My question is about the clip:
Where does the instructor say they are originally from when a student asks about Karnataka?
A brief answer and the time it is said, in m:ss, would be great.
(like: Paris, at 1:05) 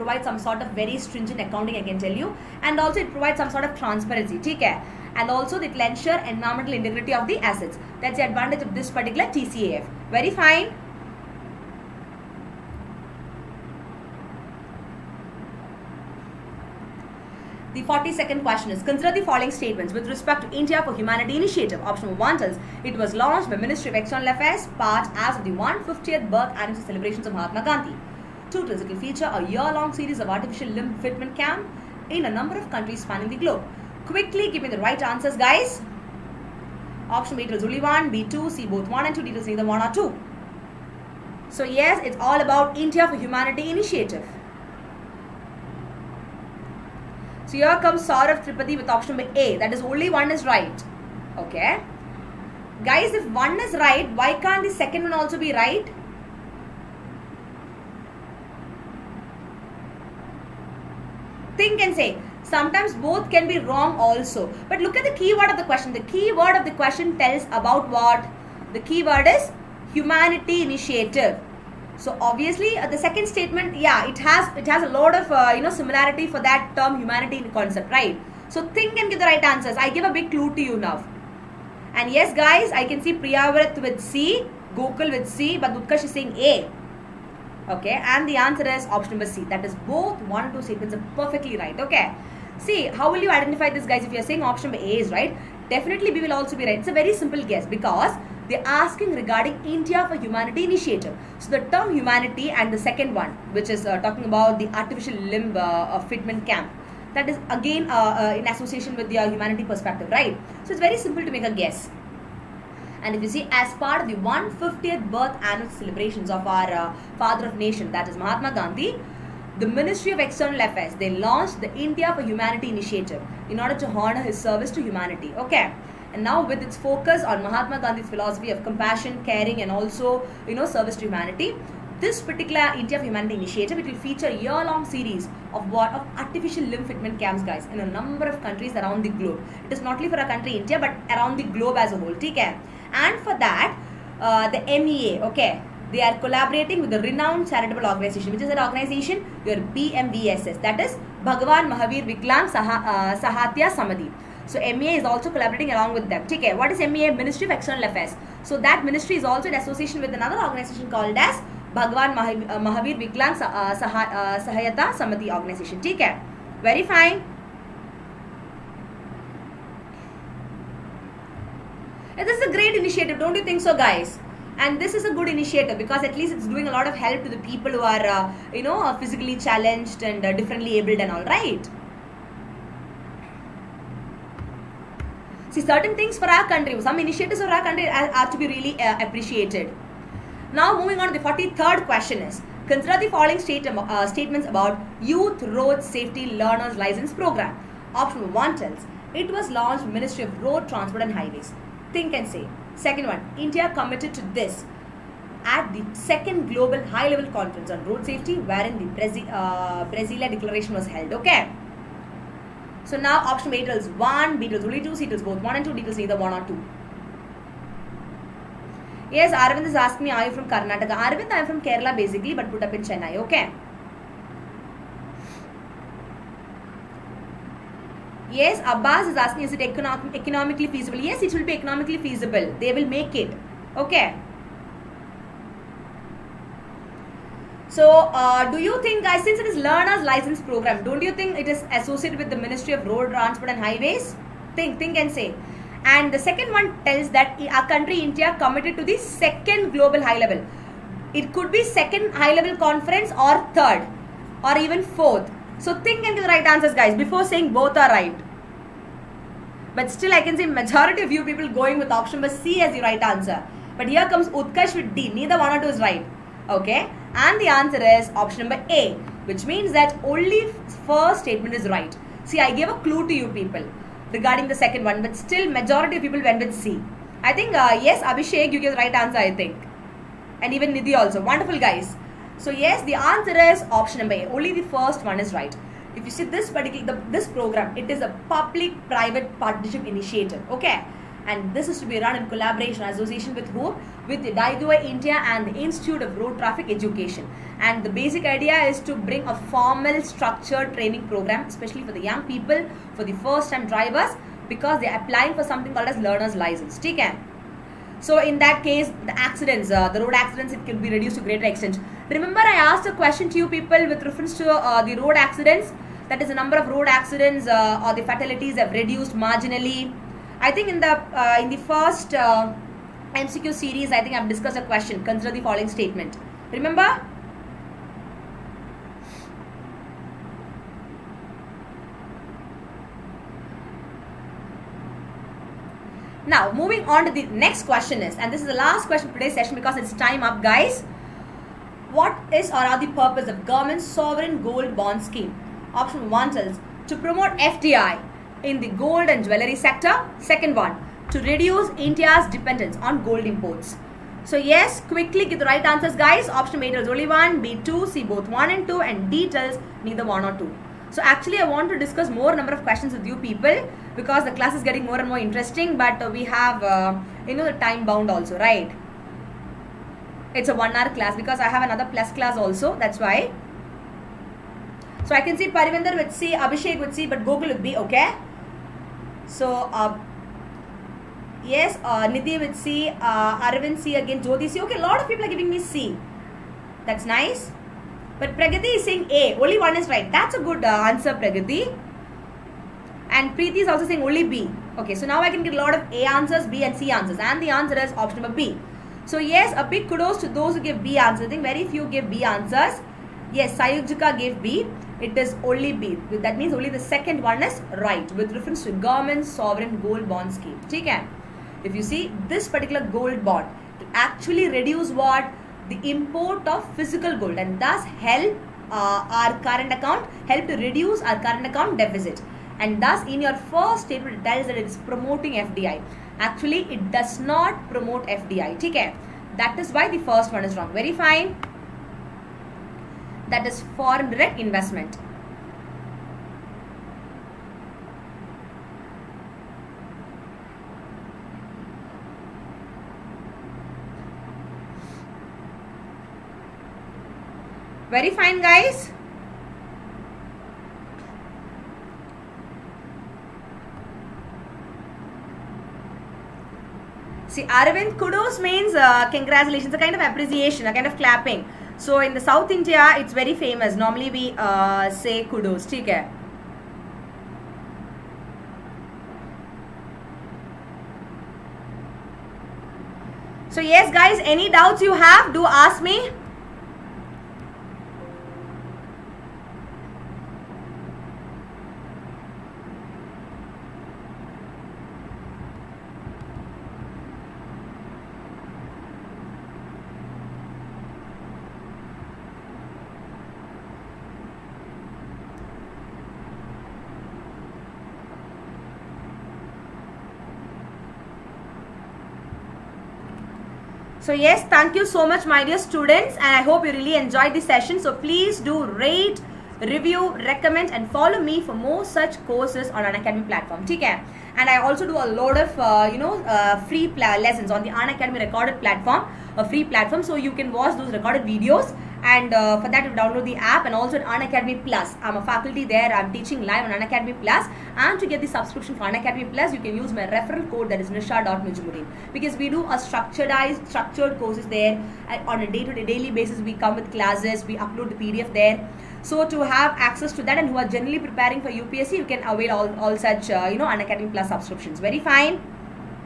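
Kerala, at 3:41.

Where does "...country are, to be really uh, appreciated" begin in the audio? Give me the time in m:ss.
3:07.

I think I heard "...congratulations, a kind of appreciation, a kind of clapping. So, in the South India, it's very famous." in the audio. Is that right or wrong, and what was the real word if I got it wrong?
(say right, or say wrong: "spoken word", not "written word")
right.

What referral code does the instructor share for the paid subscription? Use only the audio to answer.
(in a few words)
nisha.nujumudeen.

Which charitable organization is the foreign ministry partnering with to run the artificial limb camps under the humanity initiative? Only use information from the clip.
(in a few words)
BMVSS.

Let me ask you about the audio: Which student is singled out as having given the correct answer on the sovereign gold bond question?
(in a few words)
Sayujika.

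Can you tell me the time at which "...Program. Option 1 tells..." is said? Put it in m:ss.
3:17.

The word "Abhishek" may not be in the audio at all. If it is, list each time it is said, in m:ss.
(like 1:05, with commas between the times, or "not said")
4:38, 6:16.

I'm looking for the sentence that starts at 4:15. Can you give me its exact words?
So think into the right answers guys before saying both are right.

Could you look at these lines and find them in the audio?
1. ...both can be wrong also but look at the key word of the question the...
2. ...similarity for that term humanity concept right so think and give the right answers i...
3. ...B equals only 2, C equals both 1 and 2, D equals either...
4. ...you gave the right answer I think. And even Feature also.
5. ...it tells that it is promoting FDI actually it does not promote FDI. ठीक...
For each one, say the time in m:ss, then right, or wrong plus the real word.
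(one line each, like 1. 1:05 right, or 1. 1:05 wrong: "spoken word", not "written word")
1. 1:03 right
2. 1:15 right
3. 3:34 right
4. 4:38 wrong: "Nidhi", not "Feature"
5. 7:04 right.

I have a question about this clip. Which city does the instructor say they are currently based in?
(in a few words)
Chennai.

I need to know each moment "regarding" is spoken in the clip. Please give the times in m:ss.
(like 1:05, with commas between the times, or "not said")
1:39, 4:34.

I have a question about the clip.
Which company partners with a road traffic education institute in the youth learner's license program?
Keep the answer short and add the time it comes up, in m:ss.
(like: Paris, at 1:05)
Diageo India, at 4:54.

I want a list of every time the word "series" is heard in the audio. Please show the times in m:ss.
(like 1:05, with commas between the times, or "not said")
0:29, 2:14, 5:23.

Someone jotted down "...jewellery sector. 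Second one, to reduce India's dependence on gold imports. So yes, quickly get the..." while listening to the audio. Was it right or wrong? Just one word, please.
right.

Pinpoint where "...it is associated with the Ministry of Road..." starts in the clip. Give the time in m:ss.
4:01.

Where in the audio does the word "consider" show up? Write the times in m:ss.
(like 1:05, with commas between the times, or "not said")
0:18, 3:12, 5:25.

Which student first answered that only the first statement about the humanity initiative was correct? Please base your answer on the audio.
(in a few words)
Saurav Tripathi.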